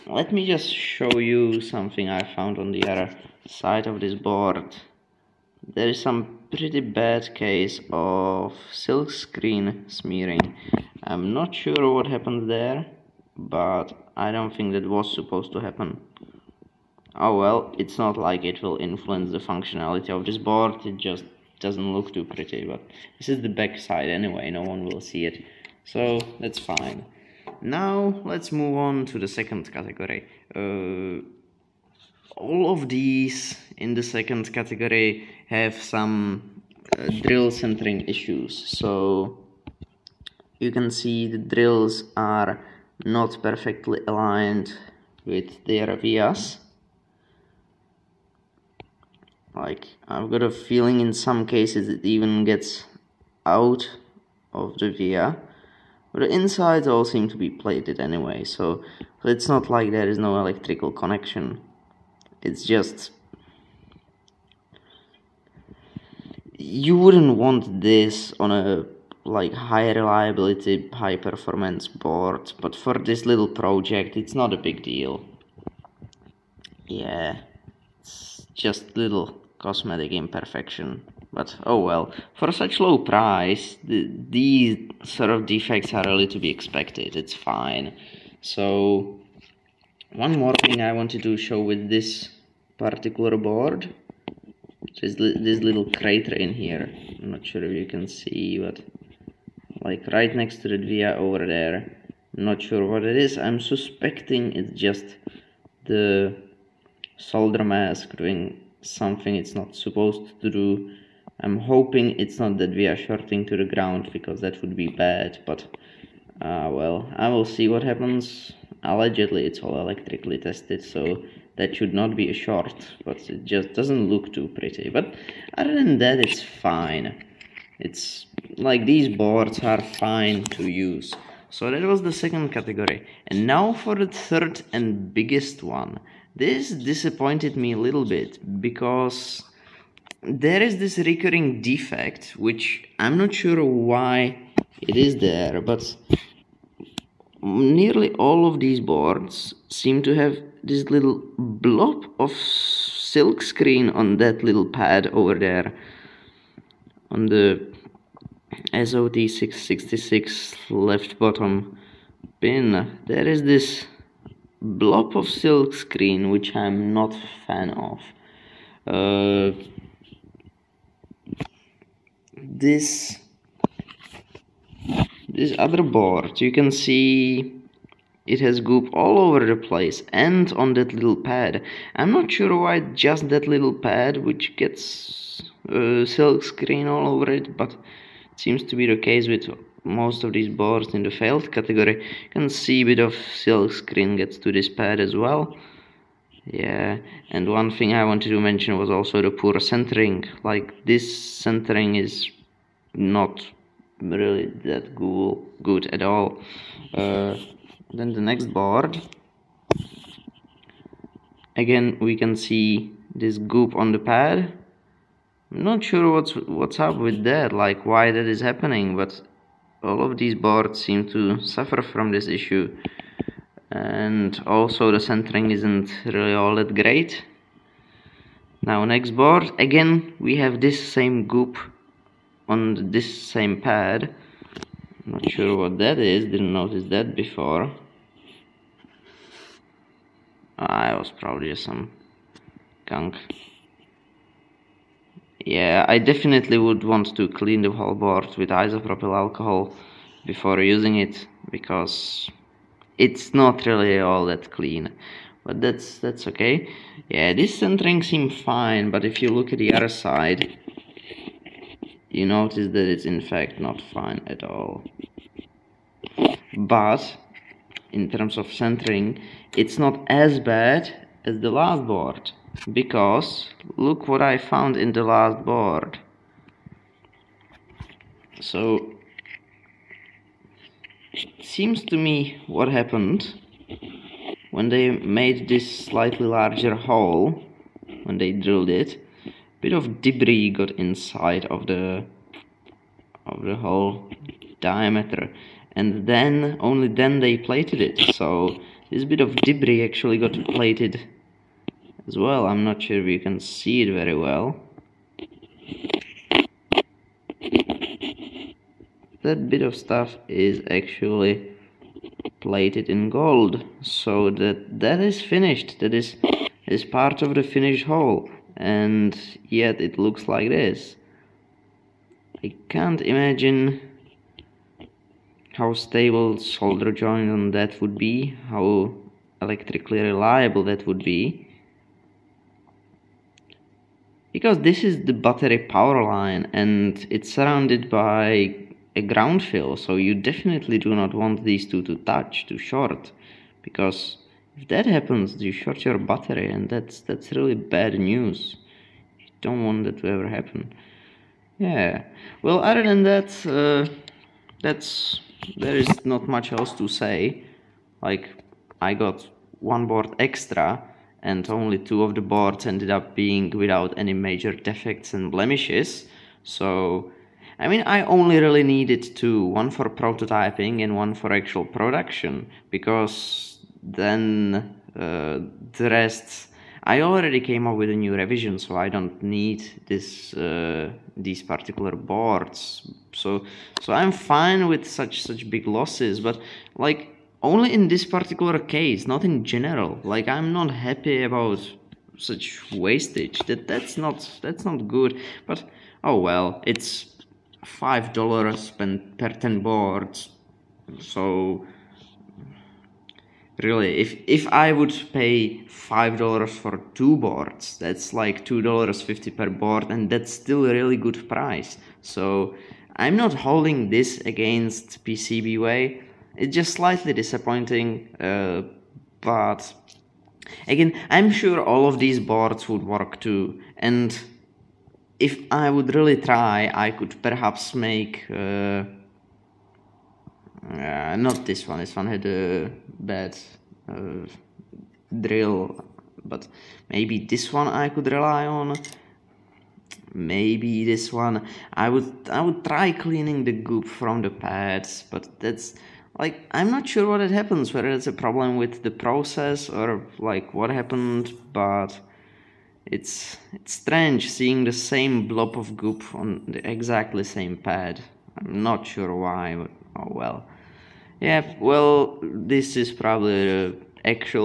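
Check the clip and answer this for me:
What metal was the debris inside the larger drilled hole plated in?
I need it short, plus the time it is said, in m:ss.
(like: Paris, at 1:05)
gold, at 5:13.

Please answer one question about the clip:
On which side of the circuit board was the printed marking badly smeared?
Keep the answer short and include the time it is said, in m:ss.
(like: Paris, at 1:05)
back side, at 0:23.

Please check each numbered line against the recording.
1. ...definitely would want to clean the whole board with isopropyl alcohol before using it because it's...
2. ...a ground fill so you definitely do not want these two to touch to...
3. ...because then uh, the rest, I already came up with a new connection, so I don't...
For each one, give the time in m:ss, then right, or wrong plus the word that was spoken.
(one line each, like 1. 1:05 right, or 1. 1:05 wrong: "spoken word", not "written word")
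1. 4:05 right
2. 5:38 right
3. 6:12 wrong: "revision", not "connection".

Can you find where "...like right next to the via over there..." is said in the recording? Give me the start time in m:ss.
1:39.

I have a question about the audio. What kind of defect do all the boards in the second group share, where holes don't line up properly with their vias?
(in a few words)
drill centering issues.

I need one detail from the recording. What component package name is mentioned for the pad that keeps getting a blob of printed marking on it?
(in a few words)
SOD666.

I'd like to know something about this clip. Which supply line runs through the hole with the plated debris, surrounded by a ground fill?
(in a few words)
battery power line.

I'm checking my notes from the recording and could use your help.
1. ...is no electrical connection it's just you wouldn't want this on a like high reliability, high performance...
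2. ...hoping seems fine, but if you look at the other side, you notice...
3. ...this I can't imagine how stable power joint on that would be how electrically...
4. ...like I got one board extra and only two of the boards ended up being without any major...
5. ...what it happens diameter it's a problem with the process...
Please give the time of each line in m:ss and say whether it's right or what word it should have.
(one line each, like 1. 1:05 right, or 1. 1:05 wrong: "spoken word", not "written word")
1. 1:00 right
2. 4:17 wrong: "centering", not "hoping"
3. 5:20 wrong: "solder", not "power"
4. 5:58 right
5. 7:27 wrong: "whether", not "diameter".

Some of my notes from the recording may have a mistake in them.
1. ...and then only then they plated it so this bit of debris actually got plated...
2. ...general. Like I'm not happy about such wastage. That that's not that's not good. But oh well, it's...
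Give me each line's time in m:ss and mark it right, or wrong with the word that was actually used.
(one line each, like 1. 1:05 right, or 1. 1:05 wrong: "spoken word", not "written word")
1. 4:55 right
2. 6:29 right.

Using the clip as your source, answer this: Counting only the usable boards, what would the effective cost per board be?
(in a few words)
$2.50.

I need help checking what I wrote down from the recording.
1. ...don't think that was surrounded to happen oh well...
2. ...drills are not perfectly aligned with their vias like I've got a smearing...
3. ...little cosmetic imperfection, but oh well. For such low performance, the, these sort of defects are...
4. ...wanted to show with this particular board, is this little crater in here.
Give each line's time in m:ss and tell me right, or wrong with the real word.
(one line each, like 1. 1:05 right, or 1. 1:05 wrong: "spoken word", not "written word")
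1. 0:14 wrong: "supposed", not "surrounded"
2. 0:41 wrong: "feeling", not "smearing"
3. 1:18 wrong: "price", not "performance"
4. 1:30 right.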